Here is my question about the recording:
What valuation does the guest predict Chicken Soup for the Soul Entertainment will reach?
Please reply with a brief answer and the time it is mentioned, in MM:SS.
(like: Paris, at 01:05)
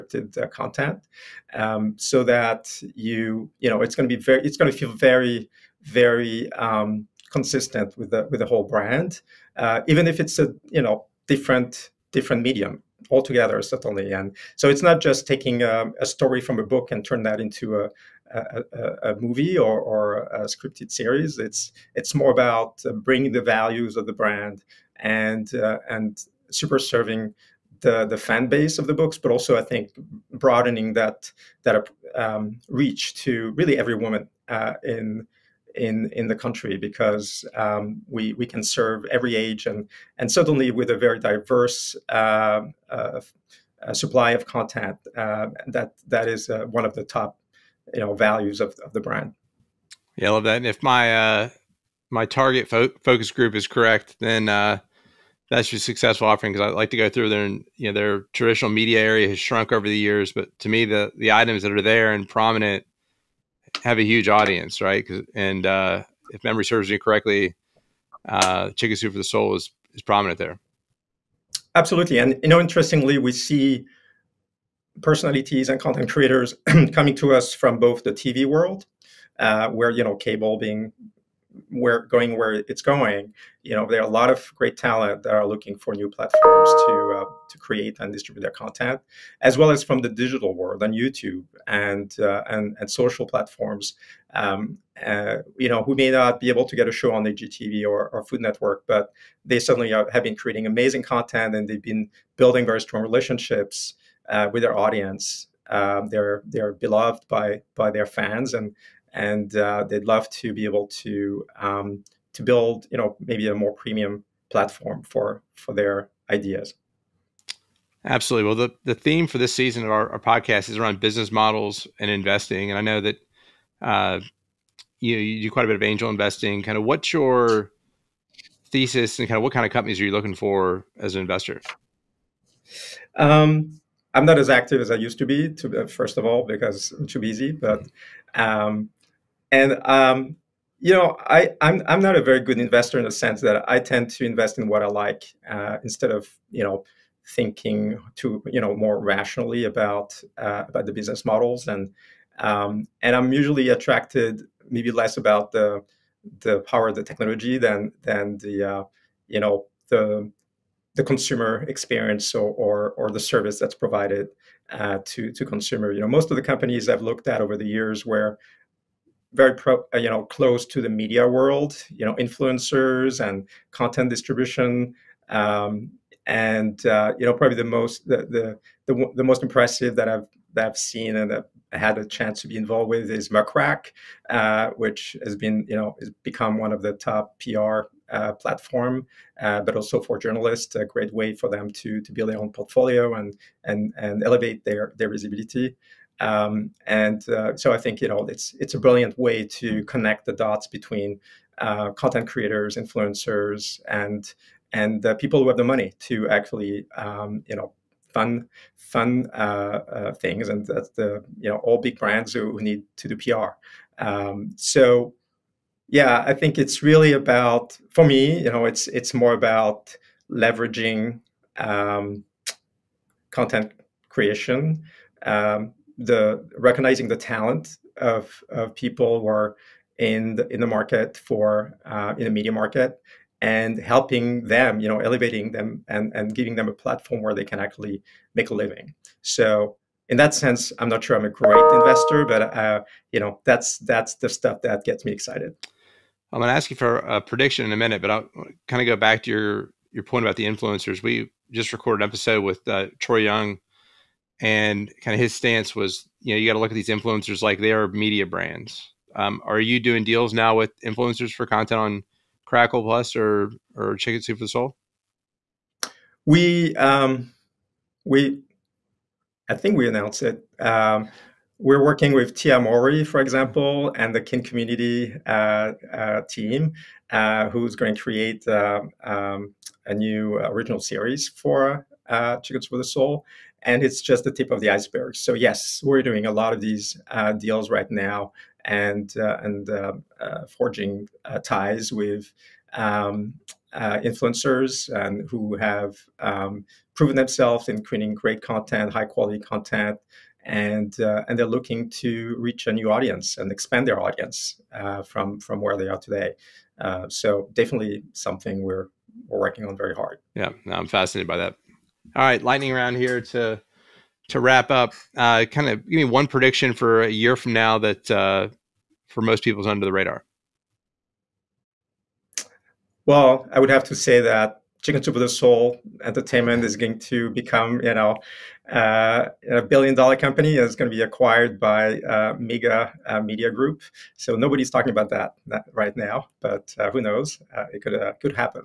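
billion-dollar, at 05:29.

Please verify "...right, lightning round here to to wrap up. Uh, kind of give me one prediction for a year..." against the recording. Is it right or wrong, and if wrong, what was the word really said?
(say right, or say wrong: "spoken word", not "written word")
right.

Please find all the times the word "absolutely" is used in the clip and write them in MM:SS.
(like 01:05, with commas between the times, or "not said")
01:11, 01:58.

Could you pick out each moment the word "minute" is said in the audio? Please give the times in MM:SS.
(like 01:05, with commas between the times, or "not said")
04:07.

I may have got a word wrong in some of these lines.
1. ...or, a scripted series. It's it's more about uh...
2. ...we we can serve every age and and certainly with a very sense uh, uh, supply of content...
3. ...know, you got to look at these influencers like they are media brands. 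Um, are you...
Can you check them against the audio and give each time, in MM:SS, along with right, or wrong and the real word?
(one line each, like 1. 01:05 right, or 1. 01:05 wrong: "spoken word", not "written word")
1. 00:19 right
2. 00:38 wrong: "diverse", not "sense"
3. 04:16 right.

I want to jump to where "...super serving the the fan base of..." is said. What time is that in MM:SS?
00:26.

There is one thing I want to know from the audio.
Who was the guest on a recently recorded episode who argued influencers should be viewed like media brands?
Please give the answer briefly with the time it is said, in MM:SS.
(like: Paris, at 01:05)
Troy Young, at 04:12.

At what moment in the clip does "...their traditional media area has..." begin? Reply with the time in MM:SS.
00:57.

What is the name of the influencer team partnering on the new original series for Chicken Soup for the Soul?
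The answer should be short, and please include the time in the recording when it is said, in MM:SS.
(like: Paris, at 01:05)
Kin Community, at 04:34.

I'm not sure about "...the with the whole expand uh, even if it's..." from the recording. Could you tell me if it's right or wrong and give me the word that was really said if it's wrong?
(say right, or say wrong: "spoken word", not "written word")
wrong: "brand", not "expand".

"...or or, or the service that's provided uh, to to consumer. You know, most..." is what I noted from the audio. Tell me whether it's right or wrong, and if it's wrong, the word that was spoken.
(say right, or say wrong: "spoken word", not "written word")
right.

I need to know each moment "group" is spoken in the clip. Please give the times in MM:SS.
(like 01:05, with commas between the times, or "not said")
00:53, 05:33.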